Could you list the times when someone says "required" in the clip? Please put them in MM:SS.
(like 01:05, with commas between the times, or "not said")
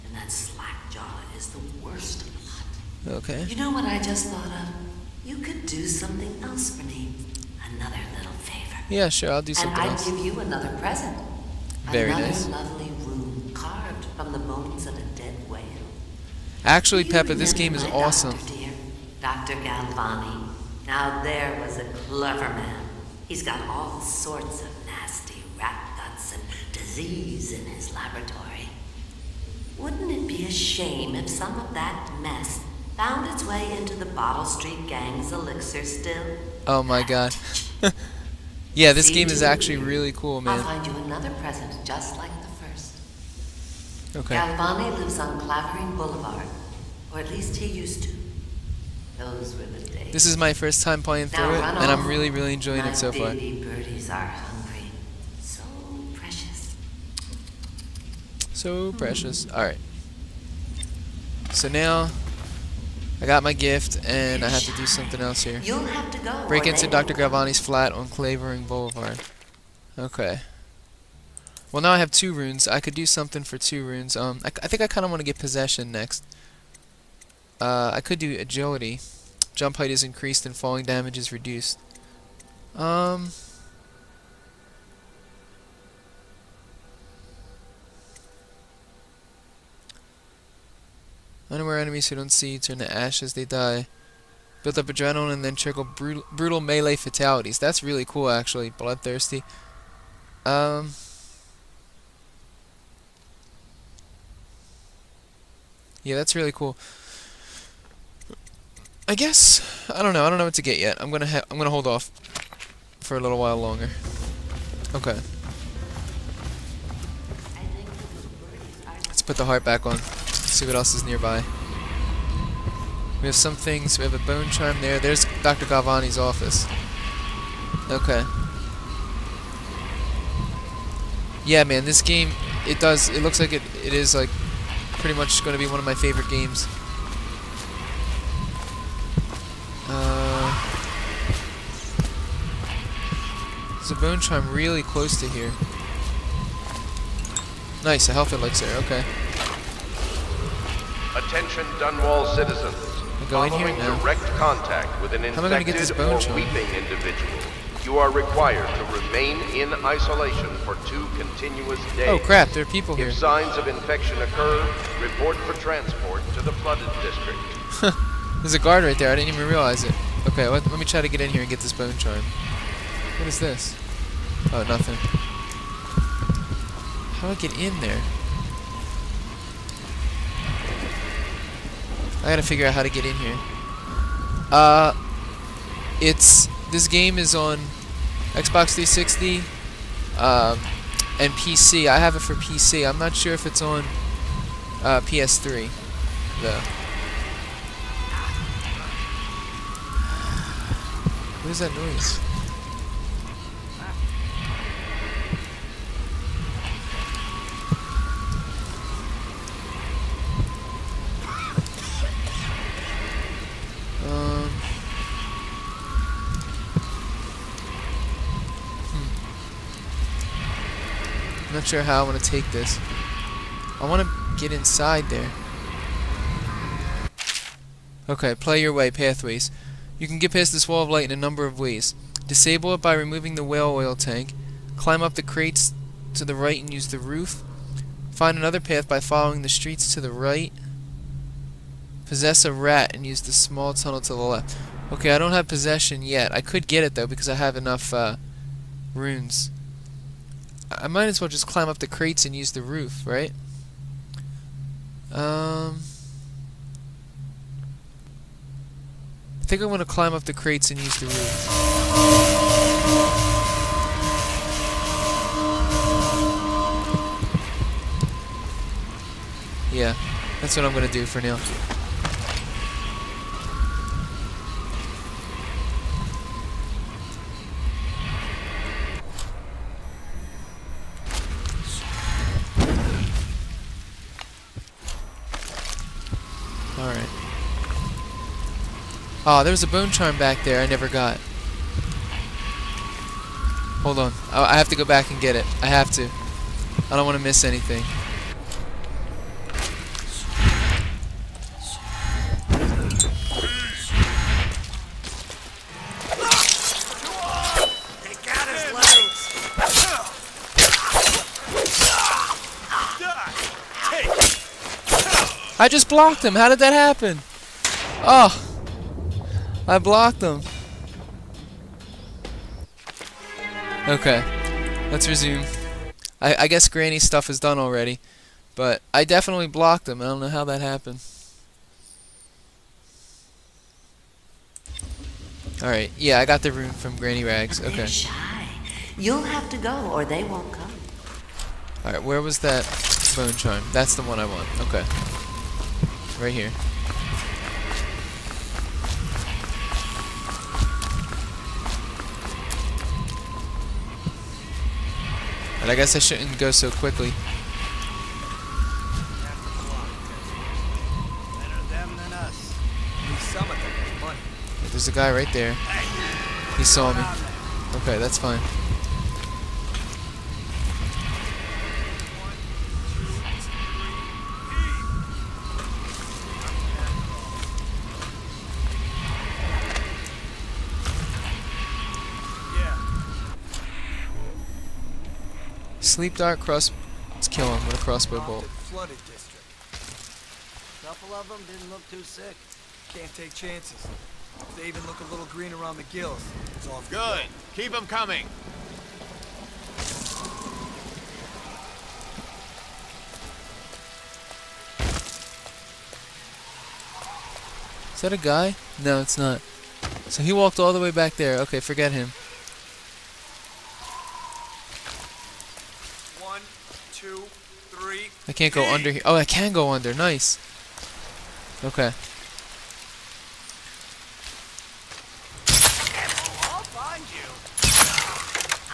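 02:38.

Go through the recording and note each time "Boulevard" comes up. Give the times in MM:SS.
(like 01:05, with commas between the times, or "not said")
00:45, 01:08.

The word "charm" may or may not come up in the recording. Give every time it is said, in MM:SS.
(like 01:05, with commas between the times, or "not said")
02:04, 02:24, 02:36, 02:51, 04:49, 05:43.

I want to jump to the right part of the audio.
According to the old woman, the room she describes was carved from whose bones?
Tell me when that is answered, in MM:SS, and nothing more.
00:14.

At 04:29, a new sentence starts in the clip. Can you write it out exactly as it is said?
Yeah, that's what I'm going to do for now.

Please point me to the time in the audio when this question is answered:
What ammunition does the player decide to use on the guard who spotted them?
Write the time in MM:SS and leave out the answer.
06:27.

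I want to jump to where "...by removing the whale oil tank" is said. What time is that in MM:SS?
03:52.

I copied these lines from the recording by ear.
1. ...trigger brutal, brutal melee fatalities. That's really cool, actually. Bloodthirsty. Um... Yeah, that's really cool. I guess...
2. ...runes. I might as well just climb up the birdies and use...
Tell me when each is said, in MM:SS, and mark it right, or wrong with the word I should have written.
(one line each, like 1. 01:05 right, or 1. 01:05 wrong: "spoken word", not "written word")
1. 01:35 right
2. 04:08 wrong: "crates", not "birdies".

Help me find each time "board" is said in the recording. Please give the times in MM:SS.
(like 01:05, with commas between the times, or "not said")
not said.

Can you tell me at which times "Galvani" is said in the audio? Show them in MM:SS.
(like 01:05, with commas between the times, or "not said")
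00:19, 00:44, 01:07, 02:05.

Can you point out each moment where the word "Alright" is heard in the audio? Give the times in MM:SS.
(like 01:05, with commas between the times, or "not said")
00:59, 05:35, 05:41.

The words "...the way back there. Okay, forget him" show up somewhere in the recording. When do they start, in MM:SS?
06:50.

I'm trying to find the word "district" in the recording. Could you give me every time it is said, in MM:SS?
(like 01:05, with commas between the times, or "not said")
02:47, 06:29.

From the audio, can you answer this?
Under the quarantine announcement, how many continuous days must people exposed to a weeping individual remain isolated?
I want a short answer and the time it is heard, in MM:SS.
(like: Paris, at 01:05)
2, at 02:40.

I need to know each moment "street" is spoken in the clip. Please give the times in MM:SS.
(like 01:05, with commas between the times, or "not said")
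00:34, 03:59.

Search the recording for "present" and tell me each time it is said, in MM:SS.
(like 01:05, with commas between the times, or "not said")
00:10, 00:41.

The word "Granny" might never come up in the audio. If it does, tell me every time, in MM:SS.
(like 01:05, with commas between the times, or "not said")
05:26, 05:36.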